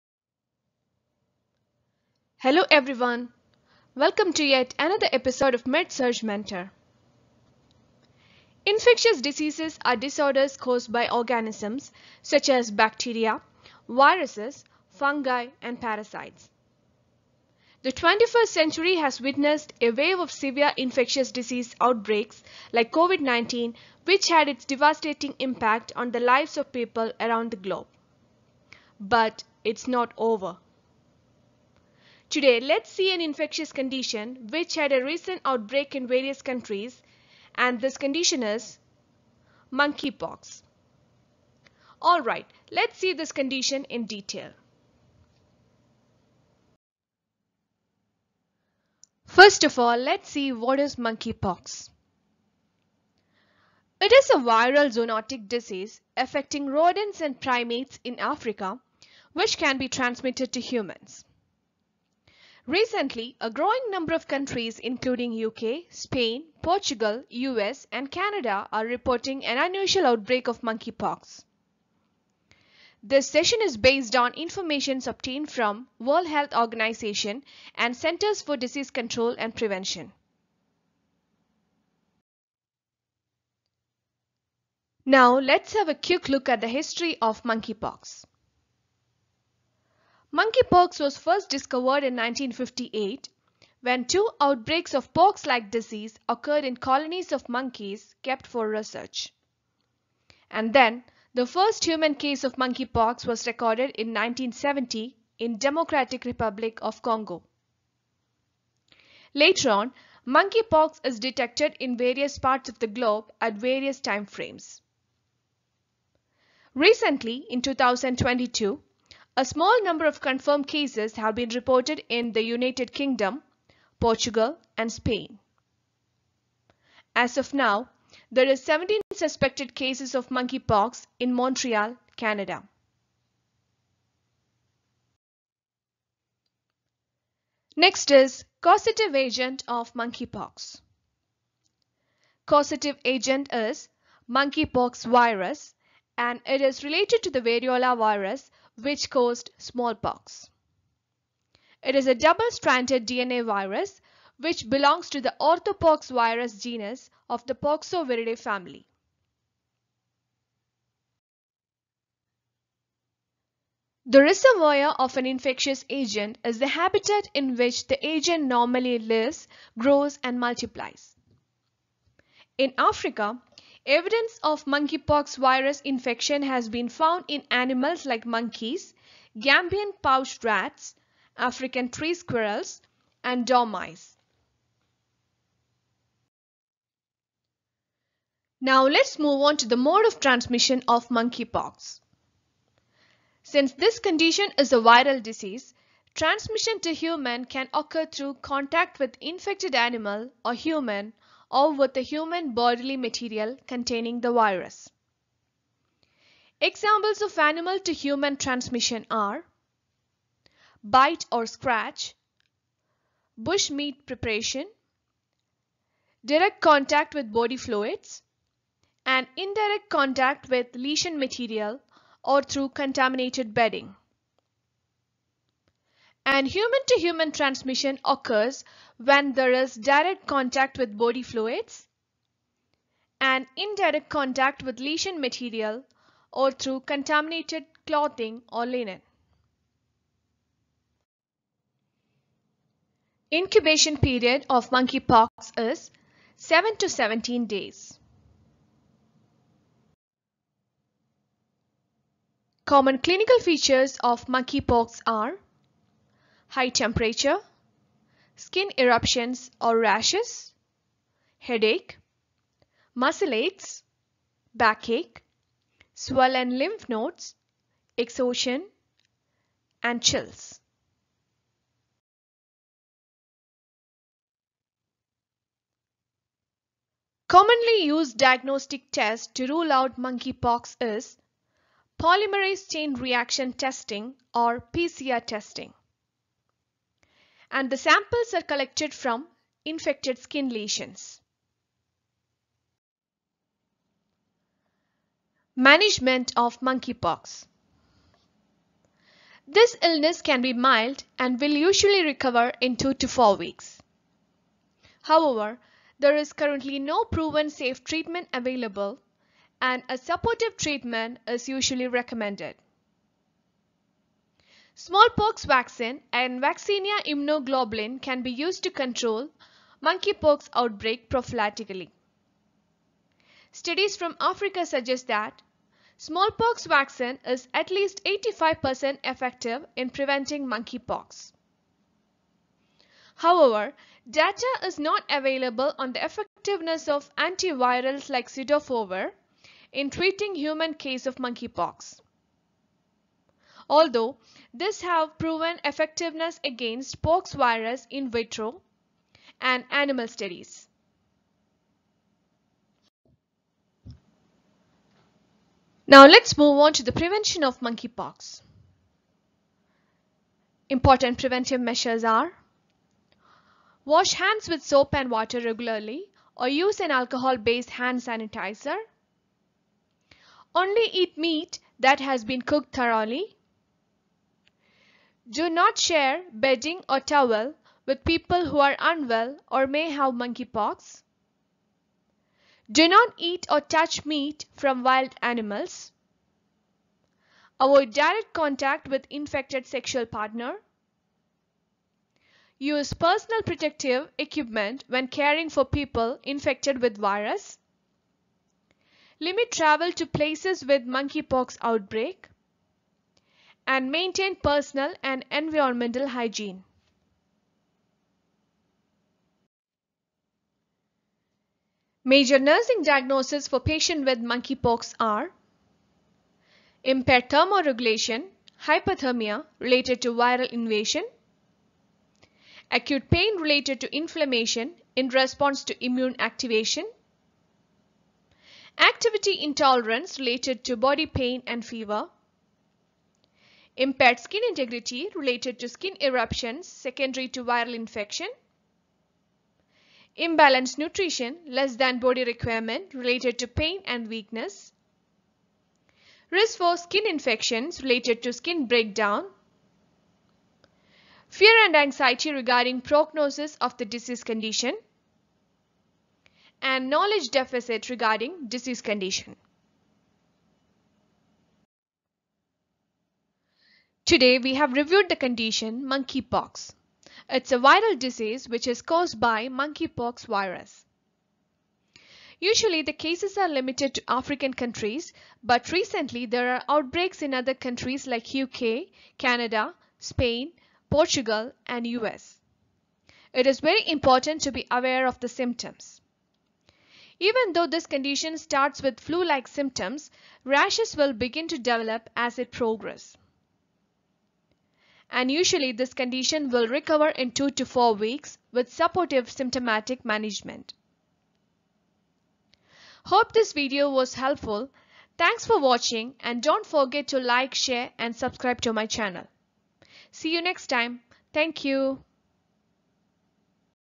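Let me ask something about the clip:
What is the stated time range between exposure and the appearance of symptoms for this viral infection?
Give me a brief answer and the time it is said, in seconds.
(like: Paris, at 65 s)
7 to 17 days, at 246 s.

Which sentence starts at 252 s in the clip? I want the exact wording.
Common clinical features of monkeypox are high temperature, skin eruptions or rashes, headache, muscle aches, backache, swollen lymph nodes, exhaustion, and chills.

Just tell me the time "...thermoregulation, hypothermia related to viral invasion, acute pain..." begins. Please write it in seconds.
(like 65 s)
417 s.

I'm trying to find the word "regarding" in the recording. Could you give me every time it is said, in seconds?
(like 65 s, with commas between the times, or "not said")
452 s, 457 s.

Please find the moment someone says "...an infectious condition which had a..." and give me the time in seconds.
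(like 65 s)
33 s.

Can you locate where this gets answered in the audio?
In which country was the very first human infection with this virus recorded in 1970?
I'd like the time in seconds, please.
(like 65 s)
105 s.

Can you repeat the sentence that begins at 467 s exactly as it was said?
It's a viral disease which is caused by monkeypox virus.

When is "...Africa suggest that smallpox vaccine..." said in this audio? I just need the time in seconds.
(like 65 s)
324 s.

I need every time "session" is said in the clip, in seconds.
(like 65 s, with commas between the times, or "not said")
73 s.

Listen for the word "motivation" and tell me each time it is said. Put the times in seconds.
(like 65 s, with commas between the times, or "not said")
not said.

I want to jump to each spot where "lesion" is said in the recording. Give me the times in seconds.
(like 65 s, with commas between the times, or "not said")
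220 s, 234 s, 290 s.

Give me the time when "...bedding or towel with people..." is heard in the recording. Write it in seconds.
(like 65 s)
376 s.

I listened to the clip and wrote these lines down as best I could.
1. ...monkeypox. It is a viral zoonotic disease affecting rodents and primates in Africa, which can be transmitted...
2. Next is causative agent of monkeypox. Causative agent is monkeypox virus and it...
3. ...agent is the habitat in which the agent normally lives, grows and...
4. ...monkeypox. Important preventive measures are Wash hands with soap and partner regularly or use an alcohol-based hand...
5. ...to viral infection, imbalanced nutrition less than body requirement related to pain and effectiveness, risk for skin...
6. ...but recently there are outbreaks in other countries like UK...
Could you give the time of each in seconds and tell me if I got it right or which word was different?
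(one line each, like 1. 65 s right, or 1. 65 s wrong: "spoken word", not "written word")
1. 50 s right
2. 137 s right
3. 165 s right
4. 357 s wrong: "water", not "partner"
5. 437 s wrong: "weakness", not "effectiveness"
6. 475 s right.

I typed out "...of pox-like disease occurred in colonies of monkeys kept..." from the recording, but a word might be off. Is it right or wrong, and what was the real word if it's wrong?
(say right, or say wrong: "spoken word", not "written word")
right.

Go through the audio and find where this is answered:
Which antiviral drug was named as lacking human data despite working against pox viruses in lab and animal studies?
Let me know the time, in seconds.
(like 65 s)
338 s.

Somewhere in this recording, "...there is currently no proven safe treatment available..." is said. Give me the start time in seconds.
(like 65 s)
305 s.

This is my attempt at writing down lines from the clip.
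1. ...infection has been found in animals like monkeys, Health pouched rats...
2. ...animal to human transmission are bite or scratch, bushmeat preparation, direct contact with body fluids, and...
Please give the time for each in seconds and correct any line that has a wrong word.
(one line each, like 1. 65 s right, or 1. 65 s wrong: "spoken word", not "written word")
1. 175 s wrong: "Gambian", not "Health"
2. 207 s right.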